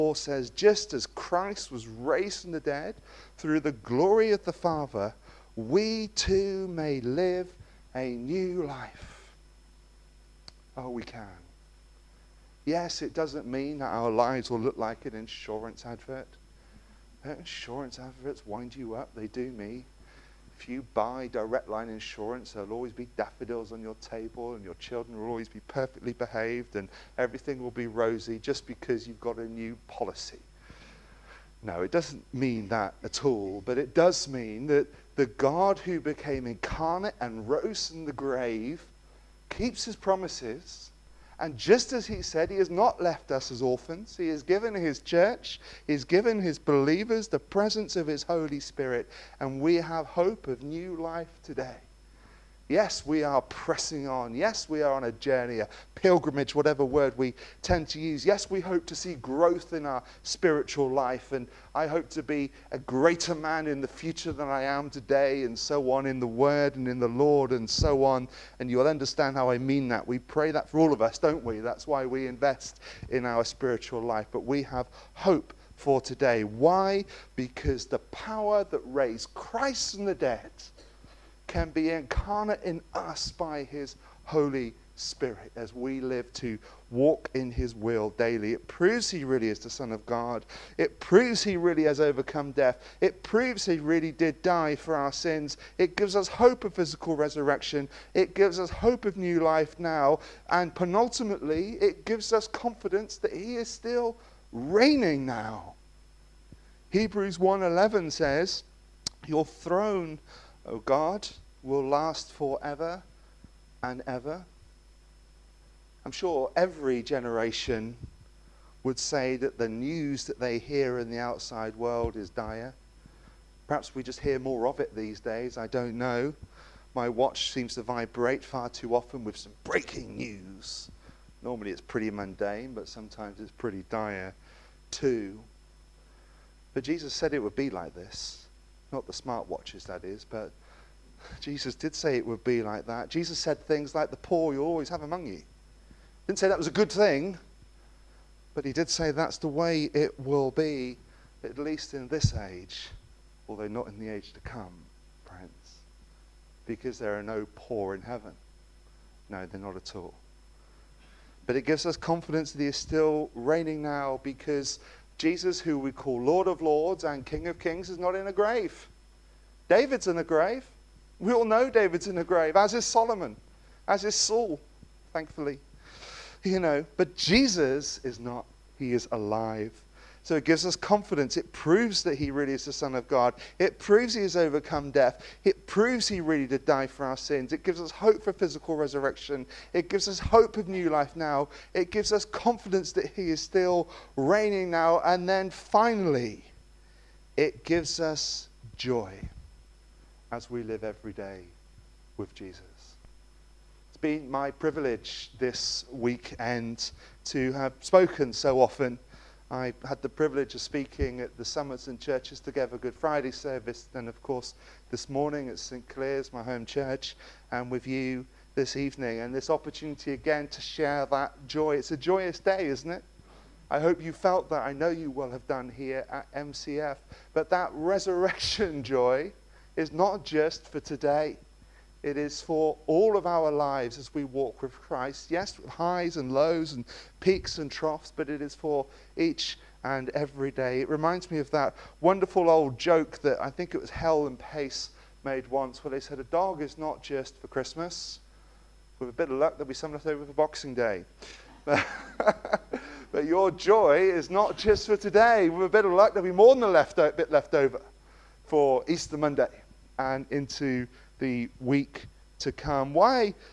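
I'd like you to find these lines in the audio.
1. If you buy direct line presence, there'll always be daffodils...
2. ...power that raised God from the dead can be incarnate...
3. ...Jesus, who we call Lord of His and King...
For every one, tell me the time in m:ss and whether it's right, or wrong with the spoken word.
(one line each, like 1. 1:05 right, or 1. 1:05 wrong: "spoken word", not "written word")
1. 0:20 wrong: "insurance", not "presence"
2. 1:17 wrong: "Christ", not "God"
3. 2:45 wrong: "Lords", not "His".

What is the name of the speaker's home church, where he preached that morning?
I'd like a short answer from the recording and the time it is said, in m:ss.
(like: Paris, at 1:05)
St. Clair's, at 3:35.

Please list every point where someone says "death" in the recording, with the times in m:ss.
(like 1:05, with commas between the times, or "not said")
1:32, 3:04.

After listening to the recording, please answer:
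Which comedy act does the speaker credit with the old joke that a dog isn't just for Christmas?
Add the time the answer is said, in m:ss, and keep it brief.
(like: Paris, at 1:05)
Hale and Pace, at 4:03.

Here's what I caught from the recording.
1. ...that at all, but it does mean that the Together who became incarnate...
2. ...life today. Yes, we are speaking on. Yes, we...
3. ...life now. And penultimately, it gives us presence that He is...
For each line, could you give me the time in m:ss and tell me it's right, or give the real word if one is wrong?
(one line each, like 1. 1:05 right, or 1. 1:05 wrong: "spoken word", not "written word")
1. 0:32 wrong: "God", not "Together"
2. 0:50 wrong: "pressing", not "speaking"
3. 1:39 wrong: "confidence", not "presence".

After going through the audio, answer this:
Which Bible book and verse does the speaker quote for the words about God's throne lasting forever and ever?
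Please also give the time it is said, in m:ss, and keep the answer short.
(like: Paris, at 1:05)
Hebrews 1:11, at 1:46.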